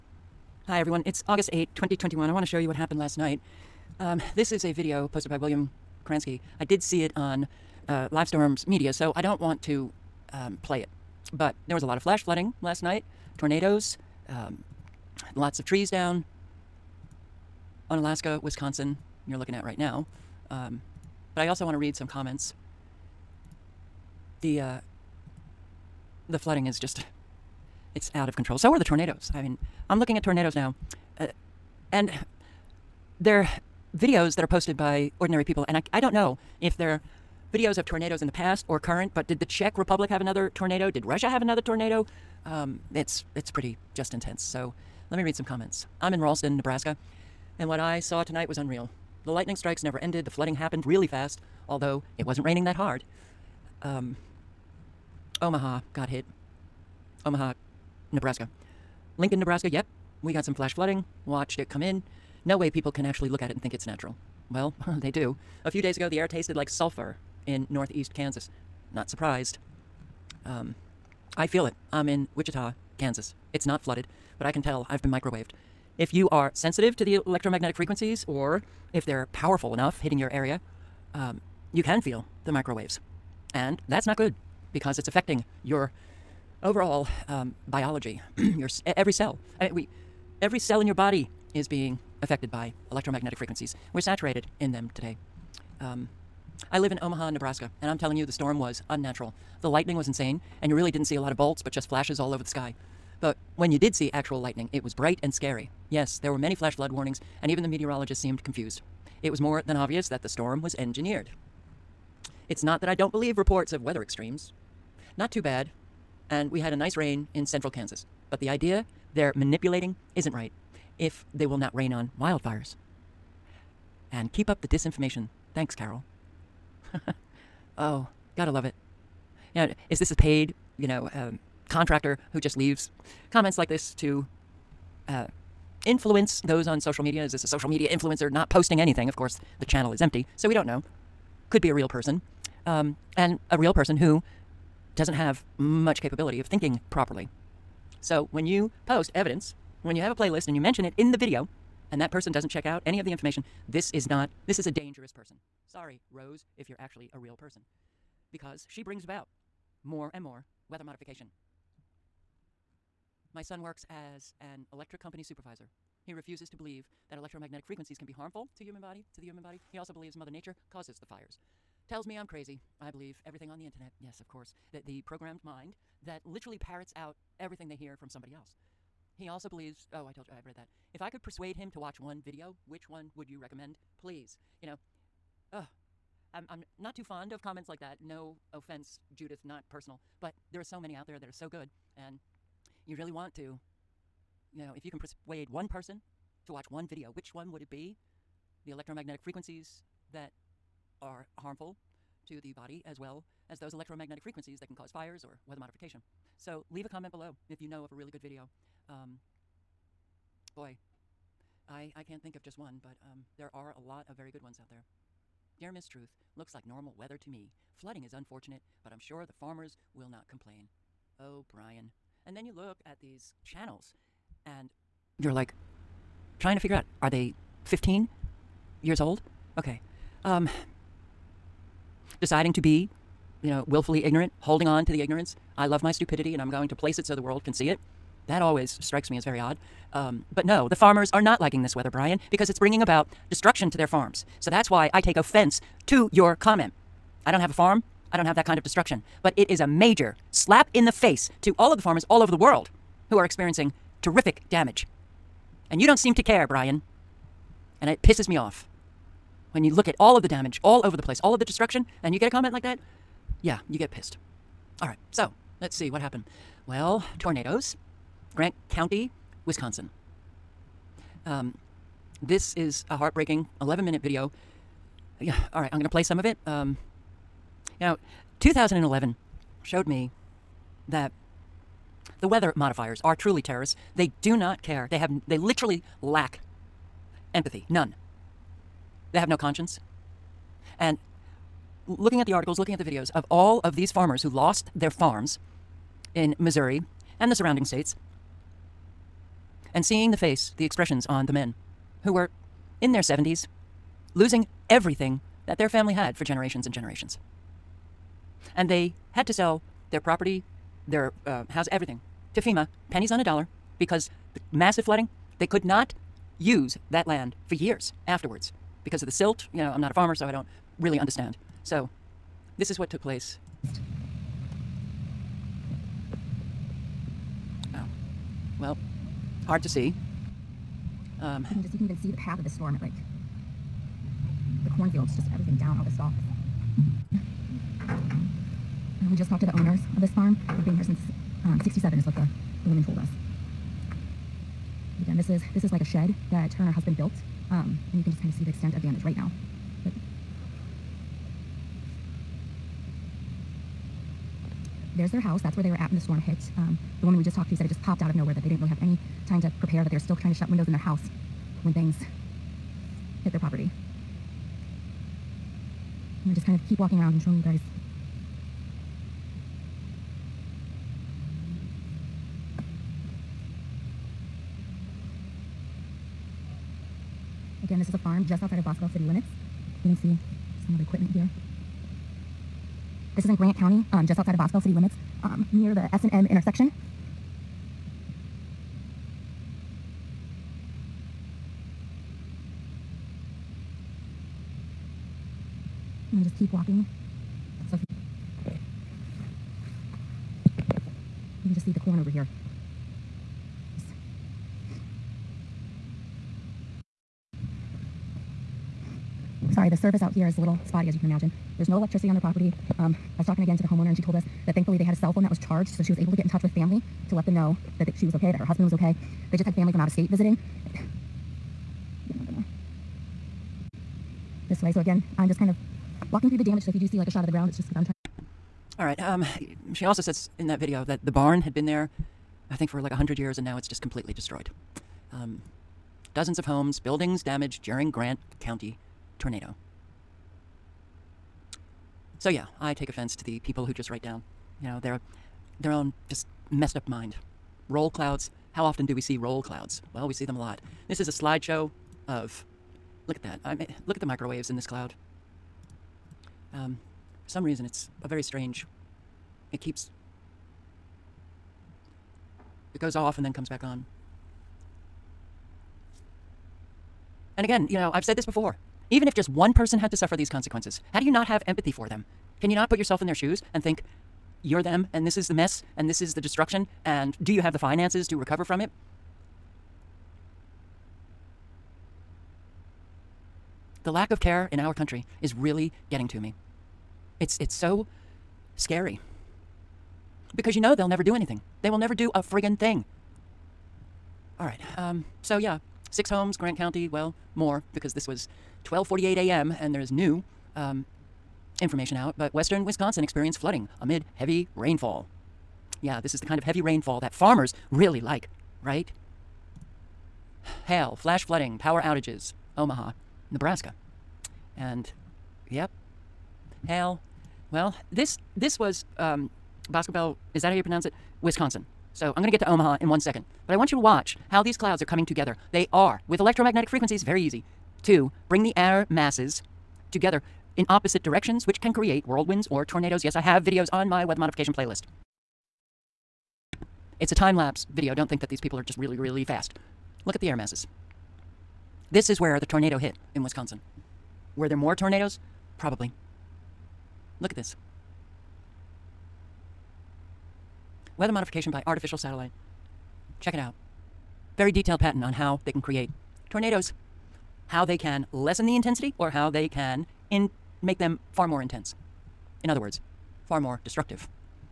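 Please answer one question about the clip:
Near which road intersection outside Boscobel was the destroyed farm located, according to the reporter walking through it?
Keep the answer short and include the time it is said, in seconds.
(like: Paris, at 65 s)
S&M intersection, at 385 s.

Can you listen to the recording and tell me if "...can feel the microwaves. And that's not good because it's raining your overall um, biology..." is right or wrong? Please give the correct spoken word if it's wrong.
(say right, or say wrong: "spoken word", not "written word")
wrong: "affecting", not "raining".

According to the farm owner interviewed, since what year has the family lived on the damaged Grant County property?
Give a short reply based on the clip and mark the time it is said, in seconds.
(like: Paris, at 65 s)
1967, at 341 s.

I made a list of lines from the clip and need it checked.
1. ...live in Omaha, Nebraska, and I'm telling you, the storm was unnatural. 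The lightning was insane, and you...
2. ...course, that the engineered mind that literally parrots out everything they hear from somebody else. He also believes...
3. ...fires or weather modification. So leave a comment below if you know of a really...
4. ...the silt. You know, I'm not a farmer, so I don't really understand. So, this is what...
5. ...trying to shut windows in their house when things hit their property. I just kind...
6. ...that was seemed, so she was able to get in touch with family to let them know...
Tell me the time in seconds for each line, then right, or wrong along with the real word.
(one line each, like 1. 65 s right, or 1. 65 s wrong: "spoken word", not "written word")
1. 96 s right
2. 174 s wrong: "programmed", not "engineered"
3. 204 s right
4. 319 s right
5. 360 s right
6. 415 s wrong: "charged", not "seemed".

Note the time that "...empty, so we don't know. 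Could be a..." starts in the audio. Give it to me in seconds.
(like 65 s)
140 s.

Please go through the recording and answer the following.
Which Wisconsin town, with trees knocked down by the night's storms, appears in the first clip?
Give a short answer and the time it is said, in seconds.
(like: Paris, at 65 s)
Onalaska, at 17 s.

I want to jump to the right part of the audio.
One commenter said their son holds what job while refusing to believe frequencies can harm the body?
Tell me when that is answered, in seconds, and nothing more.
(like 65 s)
164 s.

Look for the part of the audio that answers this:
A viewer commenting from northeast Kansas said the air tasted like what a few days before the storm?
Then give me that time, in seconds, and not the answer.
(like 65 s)
66 s.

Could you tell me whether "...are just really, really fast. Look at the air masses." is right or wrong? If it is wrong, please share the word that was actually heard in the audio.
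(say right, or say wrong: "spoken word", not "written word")
right.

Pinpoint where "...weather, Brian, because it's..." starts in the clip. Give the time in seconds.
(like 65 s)
241 s.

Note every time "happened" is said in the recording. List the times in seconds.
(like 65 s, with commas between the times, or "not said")
2 s, 50 s, 265 s.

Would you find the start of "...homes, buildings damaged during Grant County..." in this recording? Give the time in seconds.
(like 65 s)
436 s.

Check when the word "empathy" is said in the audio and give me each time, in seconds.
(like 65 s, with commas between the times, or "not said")
287 s, 471 s.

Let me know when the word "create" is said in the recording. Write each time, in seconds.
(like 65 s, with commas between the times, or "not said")
531 s, 555 s.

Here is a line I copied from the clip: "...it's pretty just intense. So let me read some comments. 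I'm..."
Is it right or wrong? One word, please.
right.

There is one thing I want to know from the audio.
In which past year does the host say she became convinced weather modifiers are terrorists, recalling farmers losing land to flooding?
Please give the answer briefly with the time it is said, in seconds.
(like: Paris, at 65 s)
2011, at 278 s.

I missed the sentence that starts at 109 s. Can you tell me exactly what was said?
It was more than obvious that the storm was engineered.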